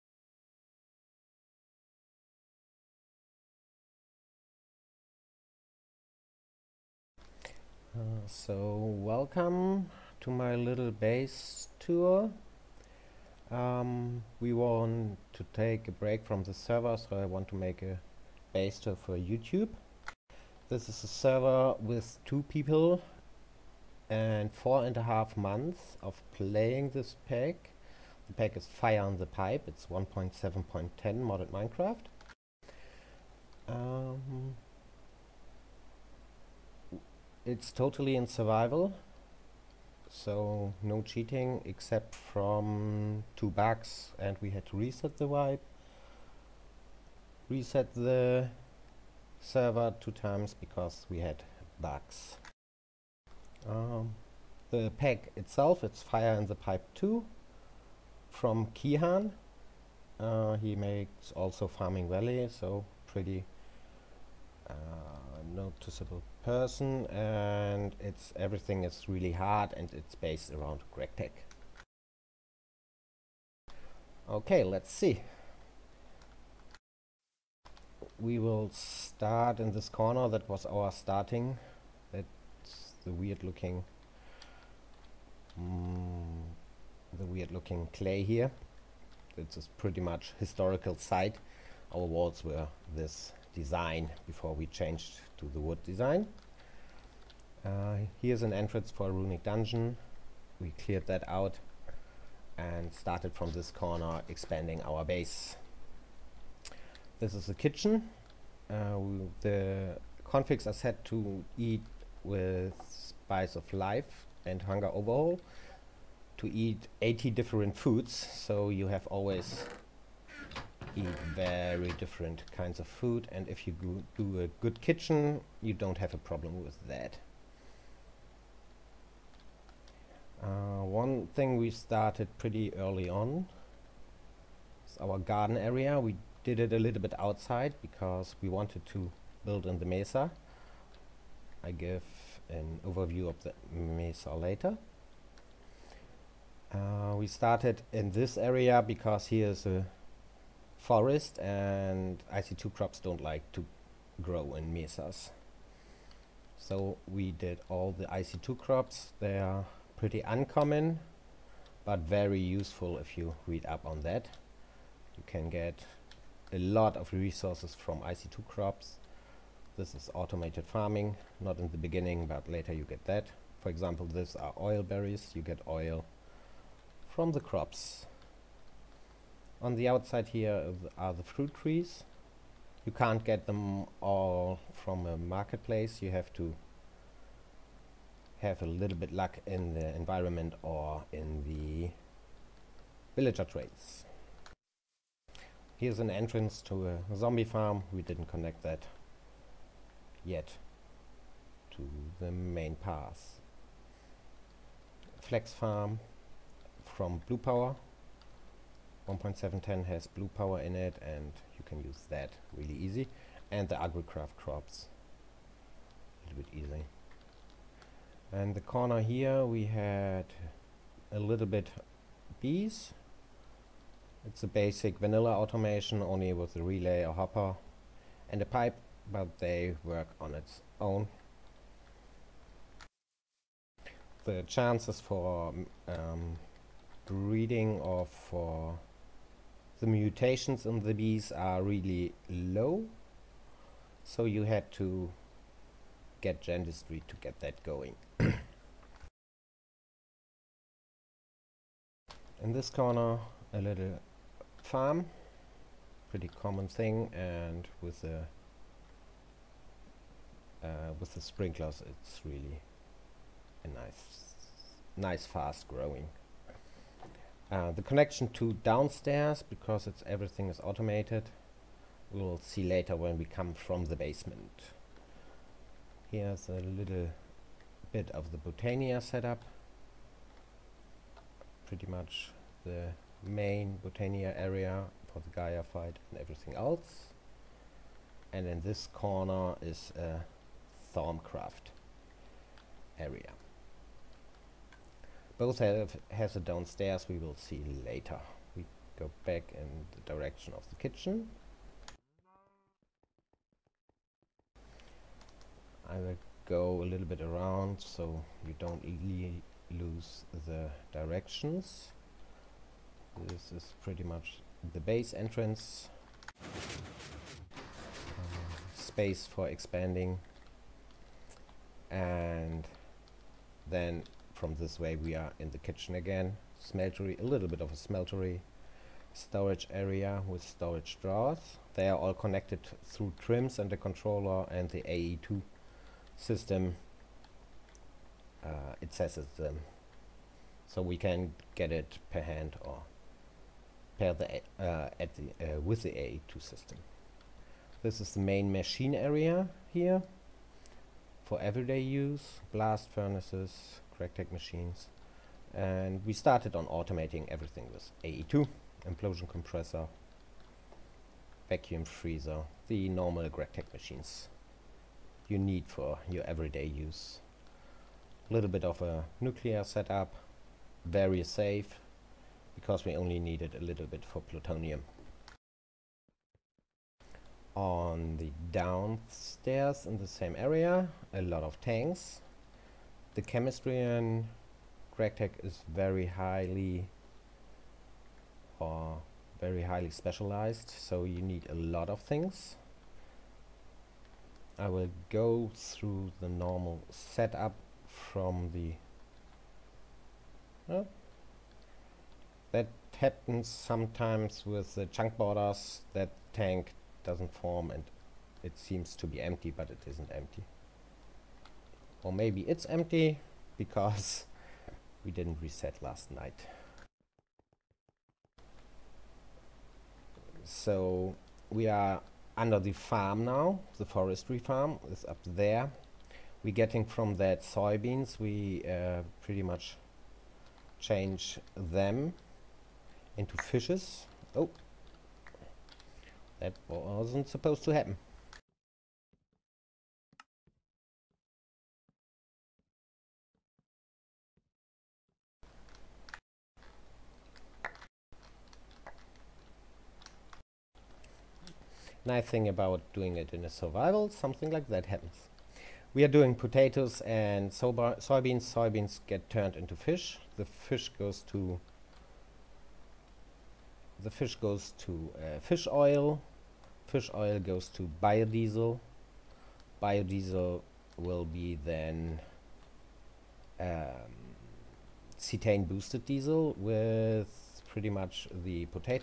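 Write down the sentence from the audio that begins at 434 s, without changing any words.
Oh, that wasn't supposed to happen.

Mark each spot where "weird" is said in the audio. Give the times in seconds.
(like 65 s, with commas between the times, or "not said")
83 s, 87 s.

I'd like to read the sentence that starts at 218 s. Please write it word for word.
And the corner here we had a little bit bees.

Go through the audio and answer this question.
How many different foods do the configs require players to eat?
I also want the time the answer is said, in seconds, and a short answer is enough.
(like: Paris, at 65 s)
80, at 117 s.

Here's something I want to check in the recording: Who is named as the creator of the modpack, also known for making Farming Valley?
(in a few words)
Kehaan.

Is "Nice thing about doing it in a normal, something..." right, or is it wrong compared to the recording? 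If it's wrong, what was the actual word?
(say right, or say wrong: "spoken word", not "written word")
wrong: "survival", not "normal".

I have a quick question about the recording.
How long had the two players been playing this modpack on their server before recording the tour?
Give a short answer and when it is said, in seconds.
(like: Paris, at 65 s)
4.5 months, at 24 s.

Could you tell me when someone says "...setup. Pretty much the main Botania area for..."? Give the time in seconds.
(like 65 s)
279 s.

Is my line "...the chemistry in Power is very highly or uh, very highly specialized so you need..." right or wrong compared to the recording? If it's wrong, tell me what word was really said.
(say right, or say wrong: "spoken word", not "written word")
wrong: "GregTech", not "Power".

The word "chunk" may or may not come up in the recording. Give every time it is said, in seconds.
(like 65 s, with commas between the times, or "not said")
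404 s.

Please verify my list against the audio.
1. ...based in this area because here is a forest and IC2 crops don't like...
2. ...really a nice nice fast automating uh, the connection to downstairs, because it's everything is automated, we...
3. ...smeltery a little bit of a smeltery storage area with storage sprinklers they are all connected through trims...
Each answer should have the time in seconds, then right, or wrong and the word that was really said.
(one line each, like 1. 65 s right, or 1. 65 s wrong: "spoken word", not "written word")
1. 147 s wrong: "started", not "based"
2. 262 s wrong: "growing", not "automating"
3. 326 s wrong: "drawers", not "sprinklers".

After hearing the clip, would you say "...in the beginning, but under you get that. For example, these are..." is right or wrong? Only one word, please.
wrong.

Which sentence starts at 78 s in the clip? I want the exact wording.
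We will start in this corner.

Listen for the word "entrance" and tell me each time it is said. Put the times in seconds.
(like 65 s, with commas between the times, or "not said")
98 s, 196 s, 315 s.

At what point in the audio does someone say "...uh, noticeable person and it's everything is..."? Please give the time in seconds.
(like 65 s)
64 s.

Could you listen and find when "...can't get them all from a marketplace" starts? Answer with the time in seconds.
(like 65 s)
182 s.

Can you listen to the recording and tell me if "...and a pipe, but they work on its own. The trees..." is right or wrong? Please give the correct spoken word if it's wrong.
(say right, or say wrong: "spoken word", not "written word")
wrong: "chances", not "trees".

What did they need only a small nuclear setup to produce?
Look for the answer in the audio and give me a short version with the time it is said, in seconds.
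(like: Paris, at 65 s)
Plutonium, at 374 s.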